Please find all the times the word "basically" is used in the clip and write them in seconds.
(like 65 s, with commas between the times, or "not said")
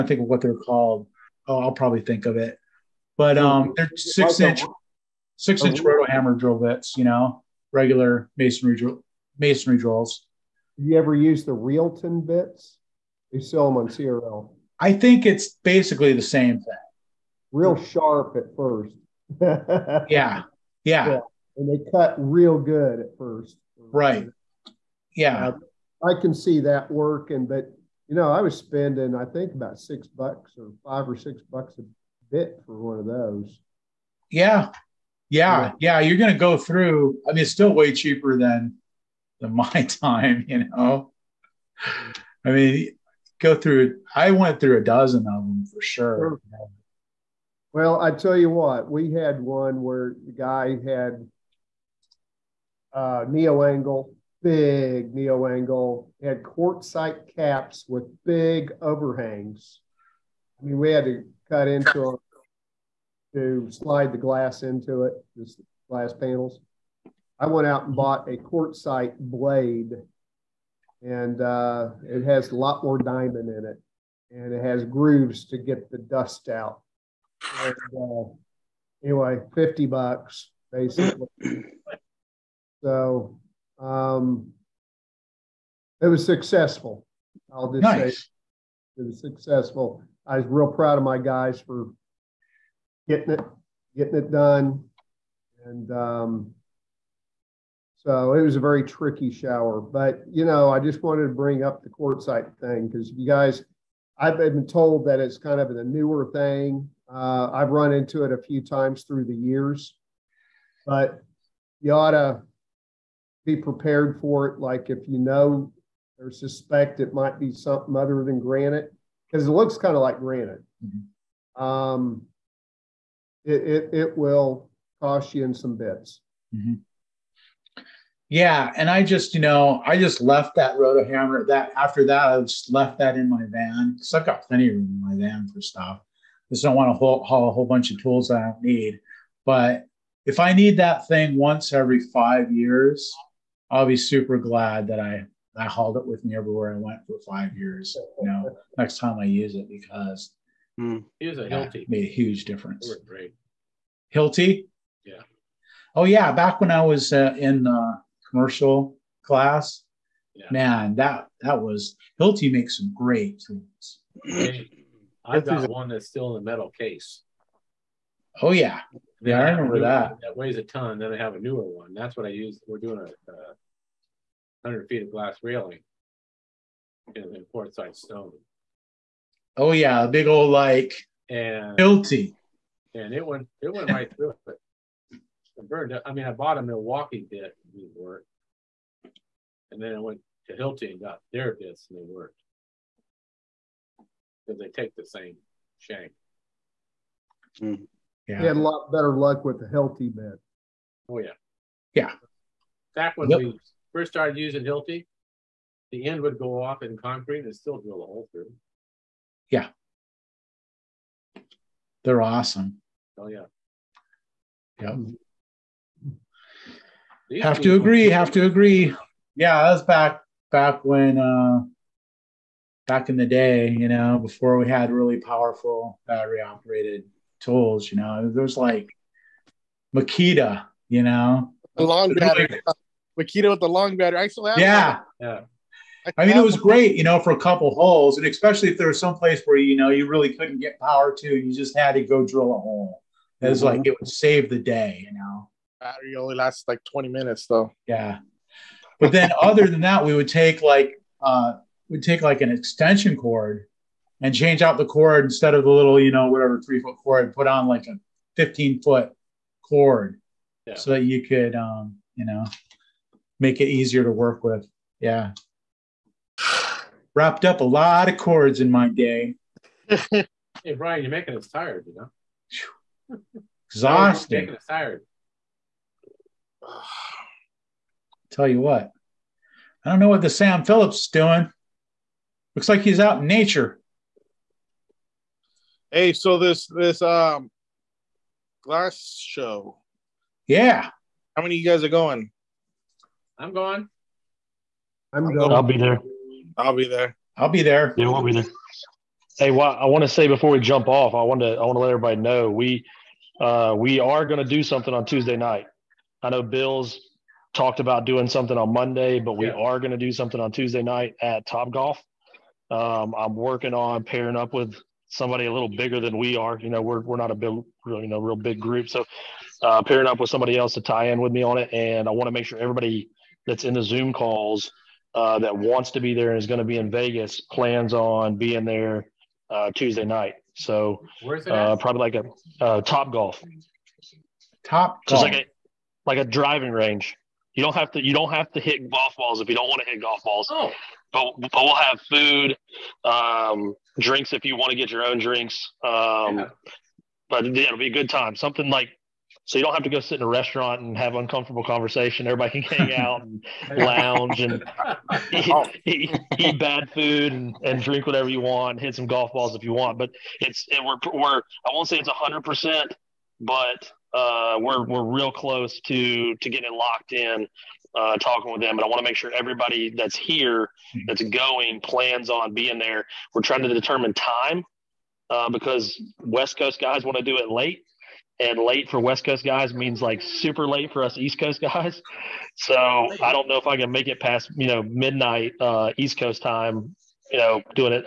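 15 s, 80 s.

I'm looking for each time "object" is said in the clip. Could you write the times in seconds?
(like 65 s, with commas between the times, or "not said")
not said.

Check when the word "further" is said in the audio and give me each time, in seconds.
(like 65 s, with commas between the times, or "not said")
not said.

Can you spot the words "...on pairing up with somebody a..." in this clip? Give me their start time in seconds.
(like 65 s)
313 s.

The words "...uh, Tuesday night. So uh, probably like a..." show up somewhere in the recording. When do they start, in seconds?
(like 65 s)
329 s.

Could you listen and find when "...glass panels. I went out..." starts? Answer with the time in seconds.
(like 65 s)
65 s.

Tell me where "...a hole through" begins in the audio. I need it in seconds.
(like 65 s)
208 s.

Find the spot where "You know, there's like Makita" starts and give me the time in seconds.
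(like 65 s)
227 s.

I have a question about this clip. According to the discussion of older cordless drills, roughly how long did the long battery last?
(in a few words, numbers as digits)
20 minutes.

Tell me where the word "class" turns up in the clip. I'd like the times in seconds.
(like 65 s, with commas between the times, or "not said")
159 s.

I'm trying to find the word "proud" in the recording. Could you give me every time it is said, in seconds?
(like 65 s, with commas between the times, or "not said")
90 s.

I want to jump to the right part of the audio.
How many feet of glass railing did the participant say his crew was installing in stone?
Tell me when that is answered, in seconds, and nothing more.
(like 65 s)
173 s.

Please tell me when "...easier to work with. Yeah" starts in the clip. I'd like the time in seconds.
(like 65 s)
263 s.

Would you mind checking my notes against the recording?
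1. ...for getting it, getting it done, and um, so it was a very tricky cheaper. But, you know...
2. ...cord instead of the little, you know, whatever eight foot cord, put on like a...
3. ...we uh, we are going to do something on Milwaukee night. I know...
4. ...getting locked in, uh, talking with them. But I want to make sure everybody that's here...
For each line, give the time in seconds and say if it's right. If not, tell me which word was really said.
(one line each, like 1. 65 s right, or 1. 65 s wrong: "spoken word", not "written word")
1. 91 s wrong: "shower", not "cheaper"
2. 254 s wrong: "three", not "eight"
3. 302 s wrong: "Tuesday", not "Milwaukee"
4. 366 s right.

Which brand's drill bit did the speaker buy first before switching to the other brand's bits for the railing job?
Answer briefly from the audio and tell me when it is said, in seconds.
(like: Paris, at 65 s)
Milwaukee, at 186 s.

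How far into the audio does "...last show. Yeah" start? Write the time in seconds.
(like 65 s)
288 s.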